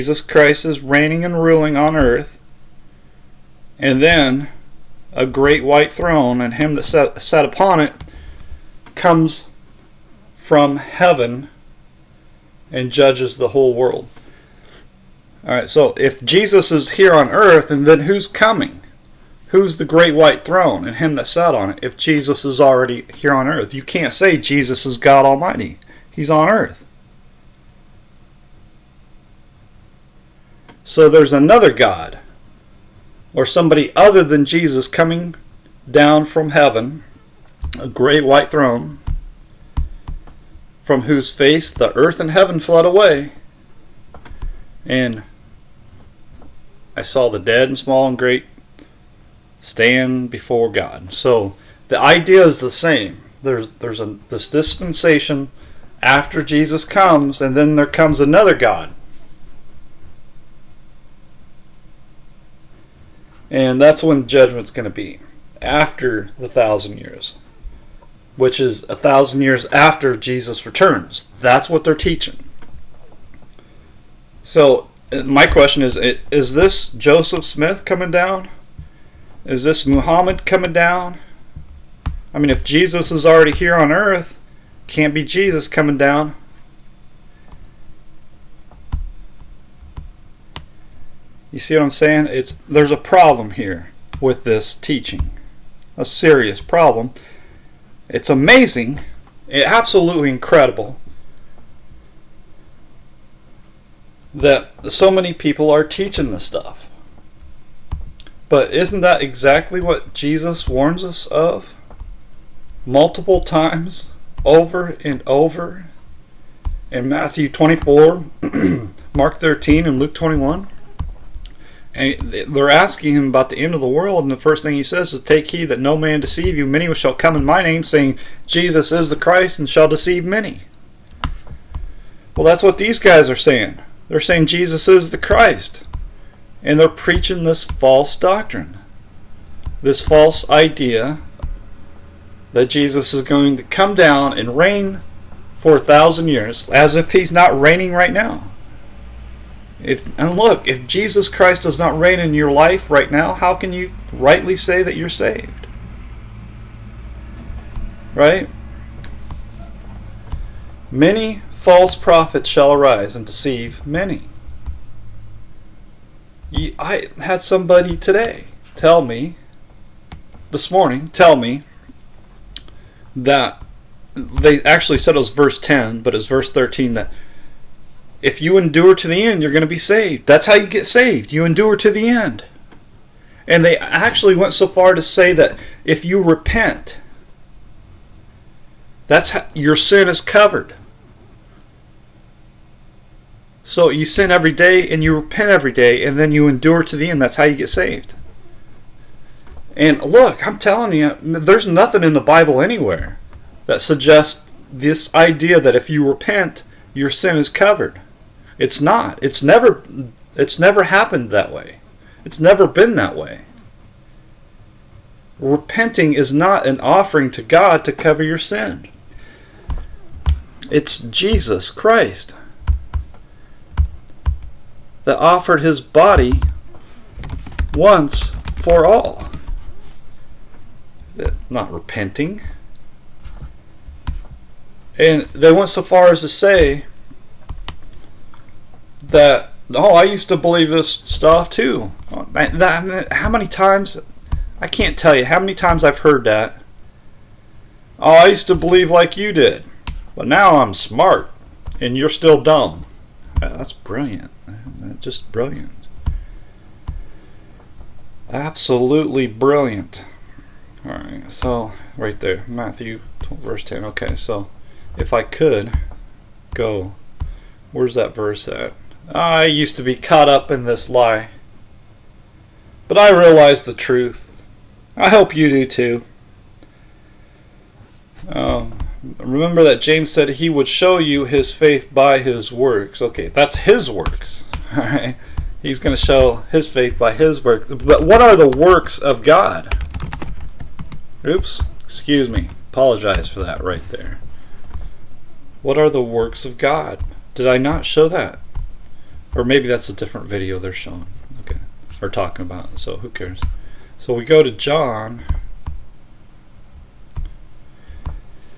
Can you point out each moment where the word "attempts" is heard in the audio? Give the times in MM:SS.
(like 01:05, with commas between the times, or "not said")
not said.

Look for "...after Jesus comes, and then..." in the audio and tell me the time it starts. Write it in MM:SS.
00:56.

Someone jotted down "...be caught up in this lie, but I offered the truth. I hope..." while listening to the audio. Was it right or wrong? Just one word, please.
wrong.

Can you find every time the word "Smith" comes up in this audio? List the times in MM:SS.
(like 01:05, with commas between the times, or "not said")
01:17.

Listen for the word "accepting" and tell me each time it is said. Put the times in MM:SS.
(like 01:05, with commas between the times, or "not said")
not said.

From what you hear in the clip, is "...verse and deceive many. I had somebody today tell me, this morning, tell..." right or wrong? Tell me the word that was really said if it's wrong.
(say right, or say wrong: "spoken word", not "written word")
wrong: "arise", not "verse".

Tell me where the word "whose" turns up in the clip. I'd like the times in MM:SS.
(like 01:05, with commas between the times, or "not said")
00:41.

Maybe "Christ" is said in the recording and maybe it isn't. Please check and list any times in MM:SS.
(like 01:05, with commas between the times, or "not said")
00:00, 02:09, 02:15, 02:31, 03:41.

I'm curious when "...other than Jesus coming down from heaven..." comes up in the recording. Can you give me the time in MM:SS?
00:33.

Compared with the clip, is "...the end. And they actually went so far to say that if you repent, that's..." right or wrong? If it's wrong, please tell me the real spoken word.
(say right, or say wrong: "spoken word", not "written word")
right.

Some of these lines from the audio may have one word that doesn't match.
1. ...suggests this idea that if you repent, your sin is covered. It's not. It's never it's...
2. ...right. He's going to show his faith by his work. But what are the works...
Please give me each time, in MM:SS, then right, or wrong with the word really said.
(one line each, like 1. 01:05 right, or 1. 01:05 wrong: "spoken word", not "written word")
1. 03:23 right
2. 04:44 right.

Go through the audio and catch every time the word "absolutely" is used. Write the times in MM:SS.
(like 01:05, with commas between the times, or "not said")
01:39, 04:18.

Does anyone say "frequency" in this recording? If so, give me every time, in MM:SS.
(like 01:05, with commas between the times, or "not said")
not said.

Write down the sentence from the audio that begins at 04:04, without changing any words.
I can't tell you how many times I've heard that.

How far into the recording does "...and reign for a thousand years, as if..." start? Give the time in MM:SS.
02:24.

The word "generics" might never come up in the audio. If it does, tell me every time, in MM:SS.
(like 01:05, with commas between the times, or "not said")
not said.